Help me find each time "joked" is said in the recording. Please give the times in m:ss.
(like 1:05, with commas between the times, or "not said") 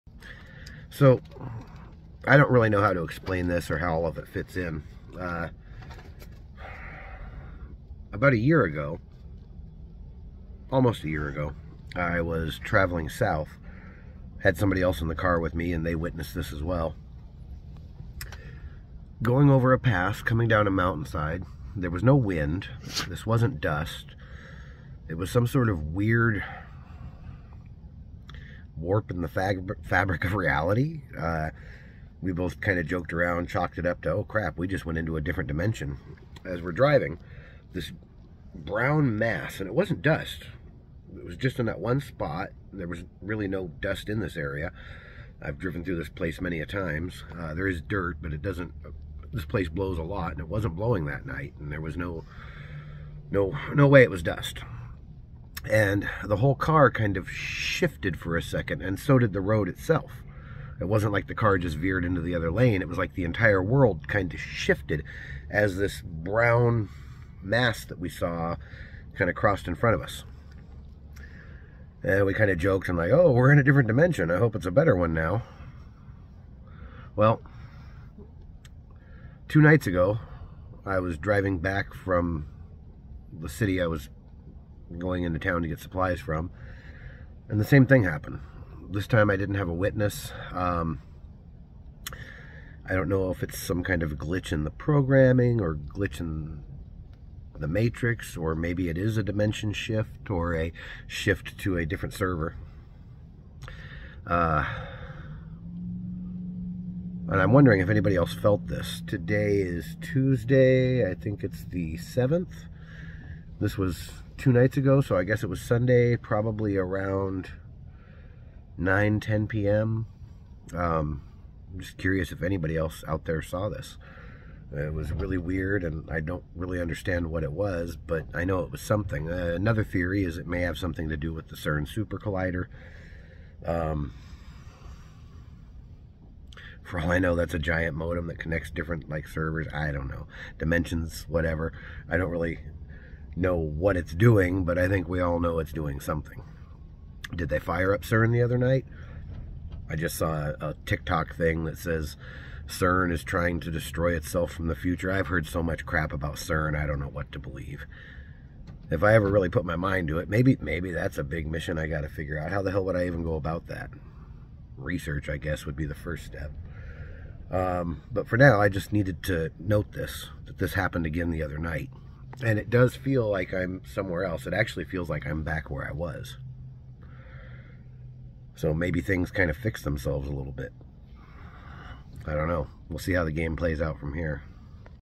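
0:32, 1:12.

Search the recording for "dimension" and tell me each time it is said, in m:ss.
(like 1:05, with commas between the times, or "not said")
0:35, 1:13, 1:39, 2:20.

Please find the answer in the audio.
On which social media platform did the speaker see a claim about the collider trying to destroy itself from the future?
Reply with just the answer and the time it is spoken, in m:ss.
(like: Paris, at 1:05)
TikTok, at 2:30.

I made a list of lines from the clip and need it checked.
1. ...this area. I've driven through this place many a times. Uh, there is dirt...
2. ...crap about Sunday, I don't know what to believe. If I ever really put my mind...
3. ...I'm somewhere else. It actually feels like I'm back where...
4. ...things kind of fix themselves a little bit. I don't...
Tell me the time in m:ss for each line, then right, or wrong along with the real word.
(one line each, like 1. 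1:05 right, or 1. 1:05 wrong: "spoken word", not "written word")
1. 0:44 right
2. 2:35 wrong: "CERN", not "Sunday"
3. 2:53 right
4. 2:59 right.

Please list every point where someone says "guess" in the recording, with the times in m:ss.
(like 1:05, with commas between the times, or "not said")
1:55, 2:45.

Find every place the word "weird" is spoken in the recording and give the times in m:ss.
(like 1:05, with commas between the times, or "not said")
0:25, 2:05.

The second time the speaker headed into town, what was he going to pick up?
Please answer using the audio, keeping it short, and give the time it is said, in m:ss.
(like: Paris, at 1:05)
Supplies, at 1:25.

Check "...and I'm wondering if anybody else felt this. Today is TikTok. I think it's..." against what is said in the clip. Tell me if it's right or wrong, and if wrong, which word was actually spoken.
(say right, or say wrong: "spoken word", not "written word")
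wrong: "Tuesday", not "TikTok".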